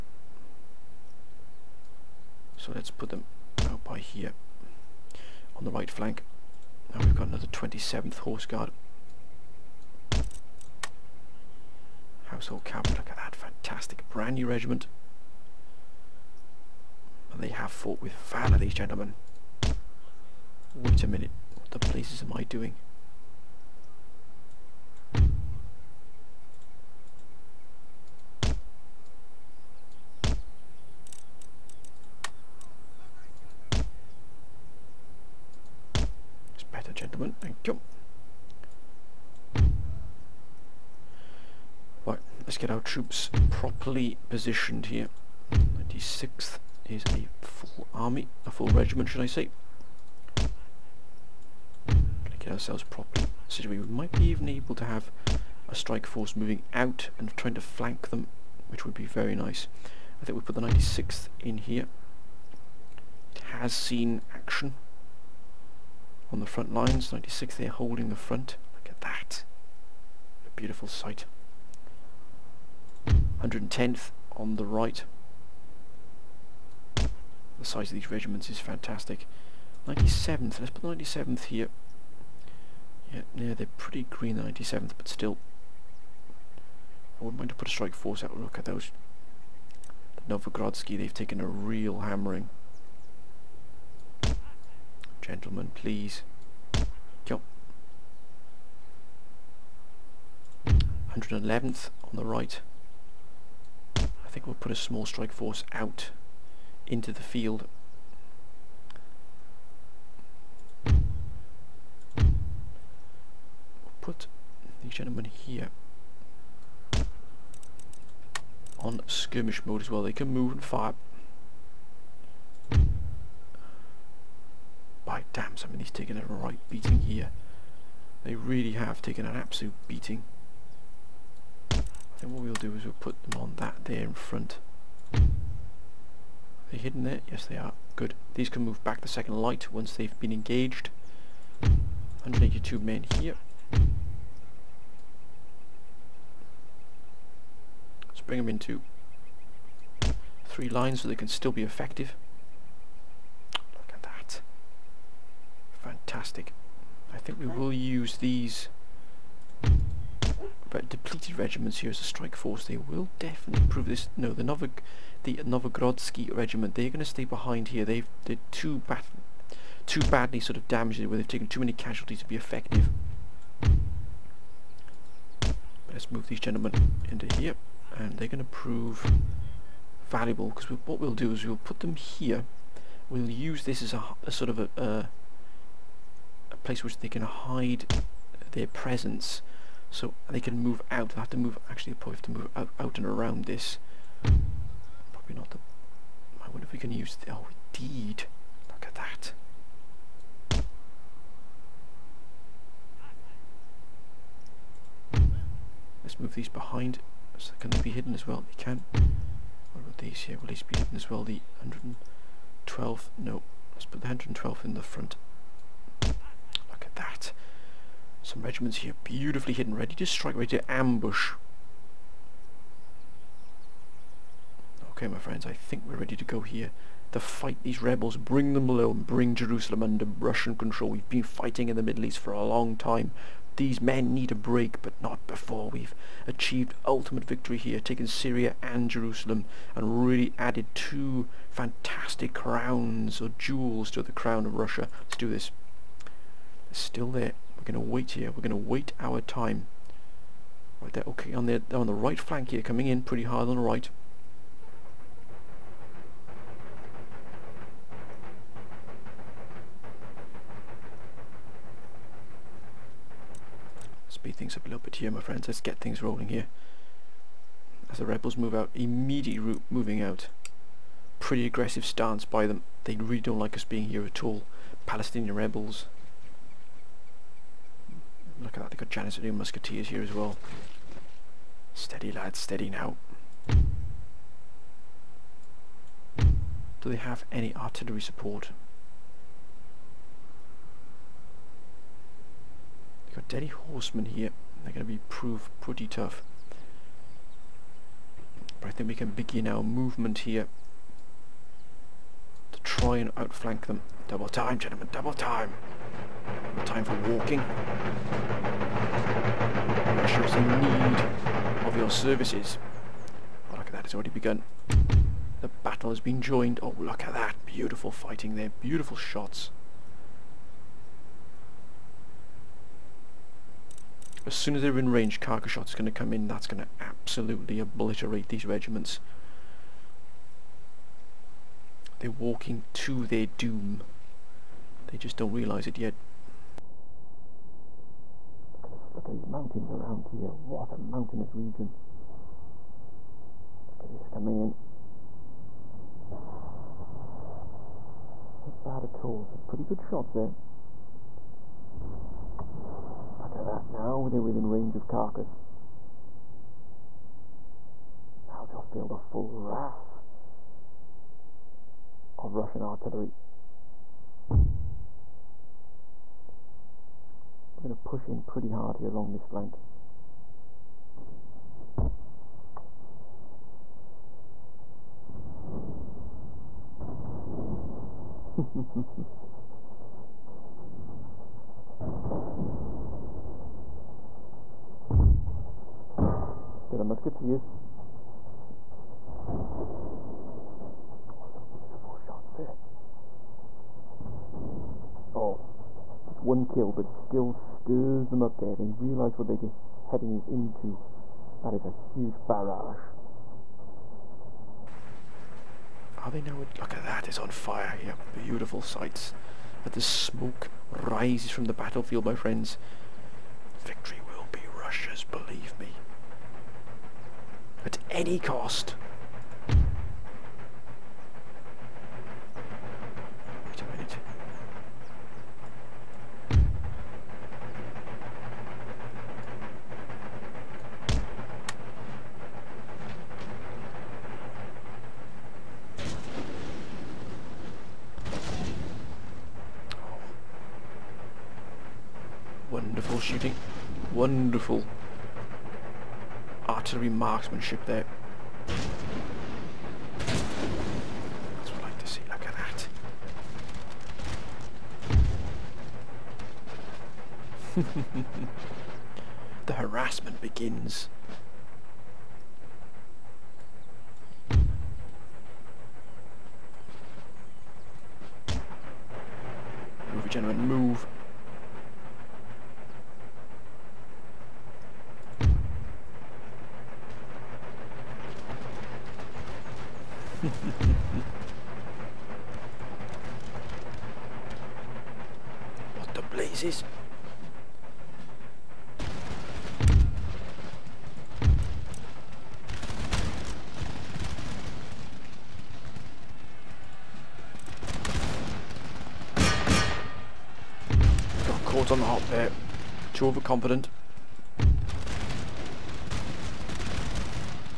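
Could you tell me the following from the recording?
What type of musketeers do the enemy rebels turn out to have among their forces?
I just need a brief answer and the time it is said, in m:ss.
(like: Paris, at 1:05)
Janissary Musketeers, at 4:38.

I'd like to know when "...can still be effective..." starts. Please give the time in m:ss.
2:31.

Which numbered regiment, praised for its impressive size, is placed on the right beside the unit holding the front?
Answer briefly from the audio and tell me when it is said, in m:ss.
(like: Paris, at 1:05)
110th, at 1:13.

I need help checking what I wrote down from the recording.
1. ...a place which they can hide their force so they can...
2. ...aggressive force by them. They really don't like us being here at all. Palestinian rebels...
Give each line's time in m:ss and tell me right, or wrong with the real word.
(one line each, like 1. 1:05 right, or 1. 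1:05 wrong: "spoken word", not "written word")
1. 3:06 wrong: "presence", not "force"
2. 4:31 wrong: "stance", not "force".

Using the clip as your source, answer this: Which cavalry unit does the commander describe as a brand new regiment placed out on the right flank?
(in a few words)
27th Horse Guard.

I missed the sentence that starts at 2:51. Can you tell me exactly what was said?
Where they've taken too many casualties to be effective.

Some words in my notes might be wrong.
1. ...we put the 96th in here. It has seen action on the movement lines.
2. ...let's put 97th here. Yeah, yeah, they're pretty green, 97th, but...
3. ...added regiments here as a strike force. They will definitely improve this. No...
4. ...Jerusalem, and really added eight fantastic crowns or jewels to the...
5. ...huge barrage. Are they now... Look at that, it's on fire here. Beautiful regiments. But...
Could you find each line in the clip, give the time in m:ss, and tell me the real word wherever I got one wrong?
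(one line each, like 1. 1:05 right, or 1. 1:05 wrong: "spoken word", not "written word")
1. 1:00 wrong: "front", not "movement"
2. 1:20 right
3. 2:40 wrong: "depleted", not "added"
4. 3:58 wrong: "two", not "eight"
5. 6:41 wrong: "sights", not "regiments".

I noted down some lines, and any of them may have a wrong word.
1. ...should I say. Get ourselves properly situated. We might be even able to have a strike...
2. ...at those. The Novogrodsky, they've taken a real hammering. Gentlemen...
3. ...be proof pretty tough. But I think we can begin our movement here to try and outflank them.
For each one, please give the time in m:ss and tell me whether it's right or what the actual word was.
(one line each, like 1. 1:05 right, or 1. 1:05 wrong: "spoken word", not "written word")
1. 0:49 right
2. 1:28 right
3. 4:54 right.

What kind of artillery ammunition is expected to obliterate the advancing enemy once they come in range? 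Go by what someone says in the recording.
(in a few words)
carcass shot.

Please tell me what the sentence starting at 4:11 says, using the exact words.
Okay, on the on the right flank here, coming in pretty hard on the right.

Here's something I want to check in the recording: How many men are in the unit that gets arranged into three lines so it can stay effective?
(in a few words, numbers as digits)
182.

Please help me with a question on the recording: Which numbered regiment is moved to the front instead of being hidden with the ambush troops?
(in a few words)
112th.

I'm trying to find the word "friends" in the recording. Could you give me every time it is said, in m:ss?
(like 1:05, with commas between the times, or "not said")
3:45, 4:25, 6:52.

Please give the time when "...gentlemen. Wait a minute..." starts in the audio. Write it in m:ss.
0:18.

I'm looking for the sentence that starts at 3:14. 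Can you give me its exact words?
Probably not the, I wonder if we can use the, oh indeed, look at that.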